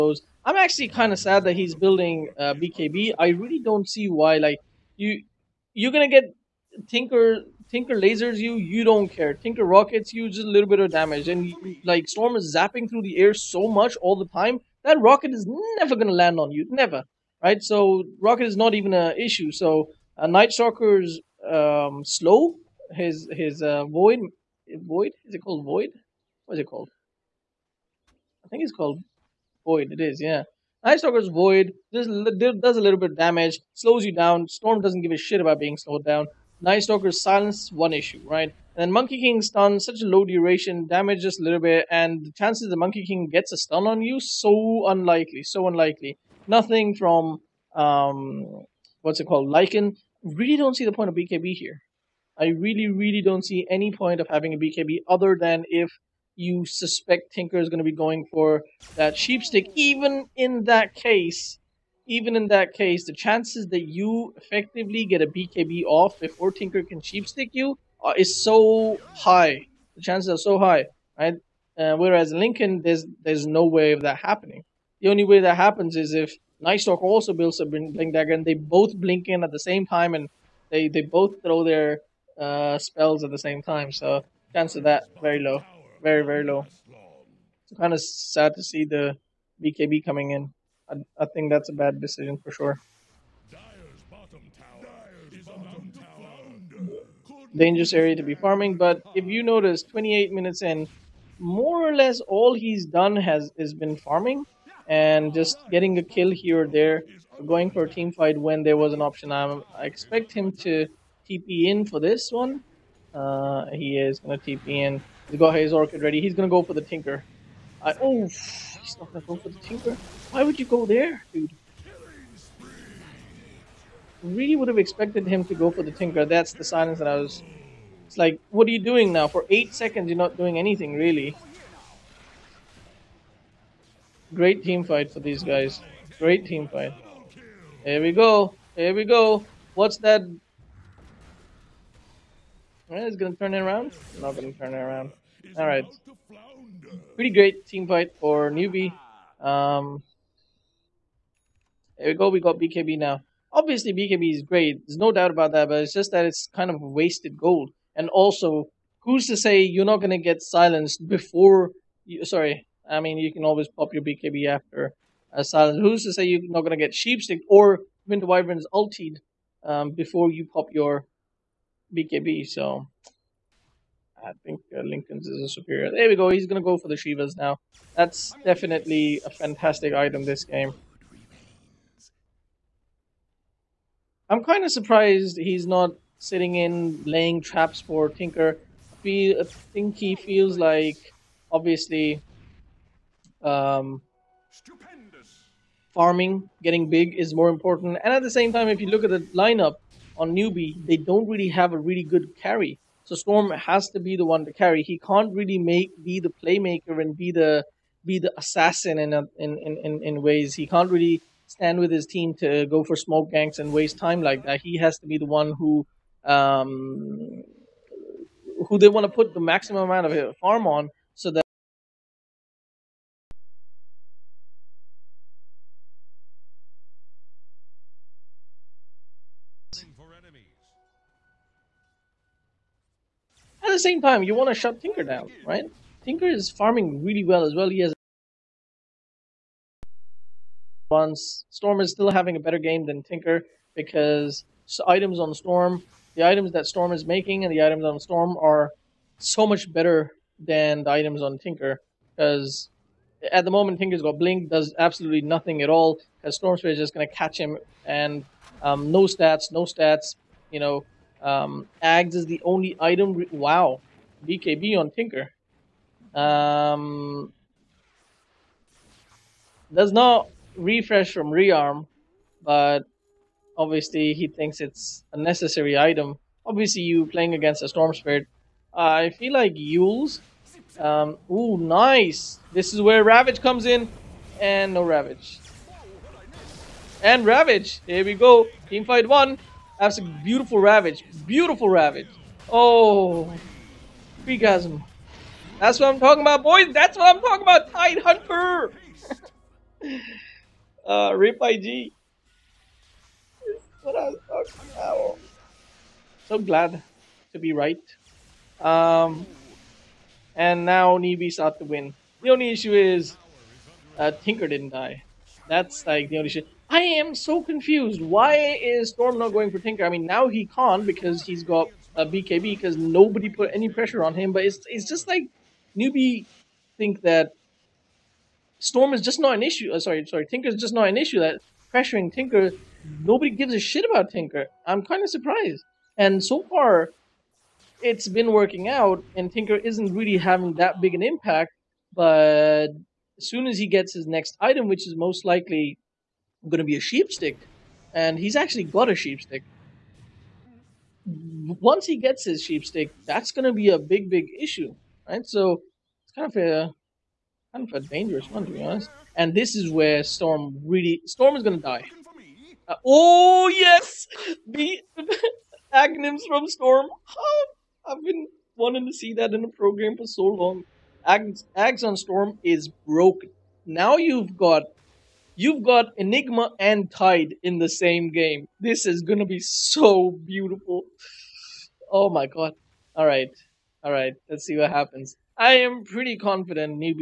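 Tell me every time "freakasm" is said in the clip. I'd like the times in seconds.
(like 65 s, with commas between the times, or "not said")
294 s.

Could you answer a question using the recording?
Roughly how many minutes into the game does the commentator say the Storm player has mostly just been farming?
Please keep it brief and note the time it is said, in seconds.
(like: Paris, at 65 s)
28, at 99 s.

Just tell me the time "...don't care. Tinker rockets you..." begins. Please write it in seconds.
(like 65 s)
8 s.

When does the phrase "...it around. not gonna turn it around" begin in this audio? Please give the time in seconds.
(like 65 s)
143 s.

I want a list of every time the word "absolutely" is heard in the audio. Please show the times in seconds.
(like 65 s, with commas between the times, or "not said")
254 s.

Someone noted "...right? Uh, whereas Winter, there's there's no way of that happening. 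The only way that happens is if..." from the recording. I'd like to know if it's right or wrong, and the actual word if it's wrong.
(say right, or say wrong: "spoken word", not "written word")
wrong: "Linken", not "Winter".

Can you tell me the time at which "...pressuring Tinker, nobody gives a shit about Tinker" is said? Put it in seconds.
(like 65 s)
331 s.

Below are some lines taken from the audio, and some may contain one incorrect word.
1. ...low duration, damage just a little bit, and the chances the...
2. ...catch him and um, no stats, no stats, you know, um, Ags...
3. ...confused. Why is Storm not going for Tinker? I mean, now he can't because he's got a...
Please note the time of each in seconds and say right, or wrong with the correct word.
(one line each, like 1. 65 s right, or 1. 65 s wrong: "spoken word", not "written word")
1. 40 s right
2. 257 s right
3. 317 s right.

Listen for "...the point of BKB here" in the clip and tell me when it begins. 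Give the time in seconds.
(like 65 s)
50 s.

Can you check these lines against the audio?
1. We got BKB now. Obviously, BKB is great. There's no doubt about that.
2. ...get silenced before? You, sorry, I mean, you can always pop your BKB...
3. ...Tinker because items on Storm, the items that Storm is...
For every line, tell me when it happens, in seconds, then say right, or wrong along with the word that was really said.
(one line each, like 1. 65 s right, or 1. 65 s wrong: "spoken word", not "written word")
1. 152 s right
2. 160 s right
3. 243 s right.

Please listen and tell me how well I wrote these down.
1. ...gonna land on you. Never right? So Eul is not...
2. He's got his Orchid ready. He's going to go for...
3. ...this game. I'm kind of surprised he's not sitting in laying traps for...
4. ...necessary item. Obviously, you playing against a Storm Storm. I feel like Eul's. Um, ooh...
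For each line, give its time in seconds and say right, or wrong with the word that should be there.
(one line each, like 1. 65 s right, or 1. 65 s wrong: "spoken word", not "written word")
1. 15 s wrong: "Rocket", not "Eul"
2. 115 s right
3. 180 s right
4. 275 s wrong: "Spirit", not "Storm".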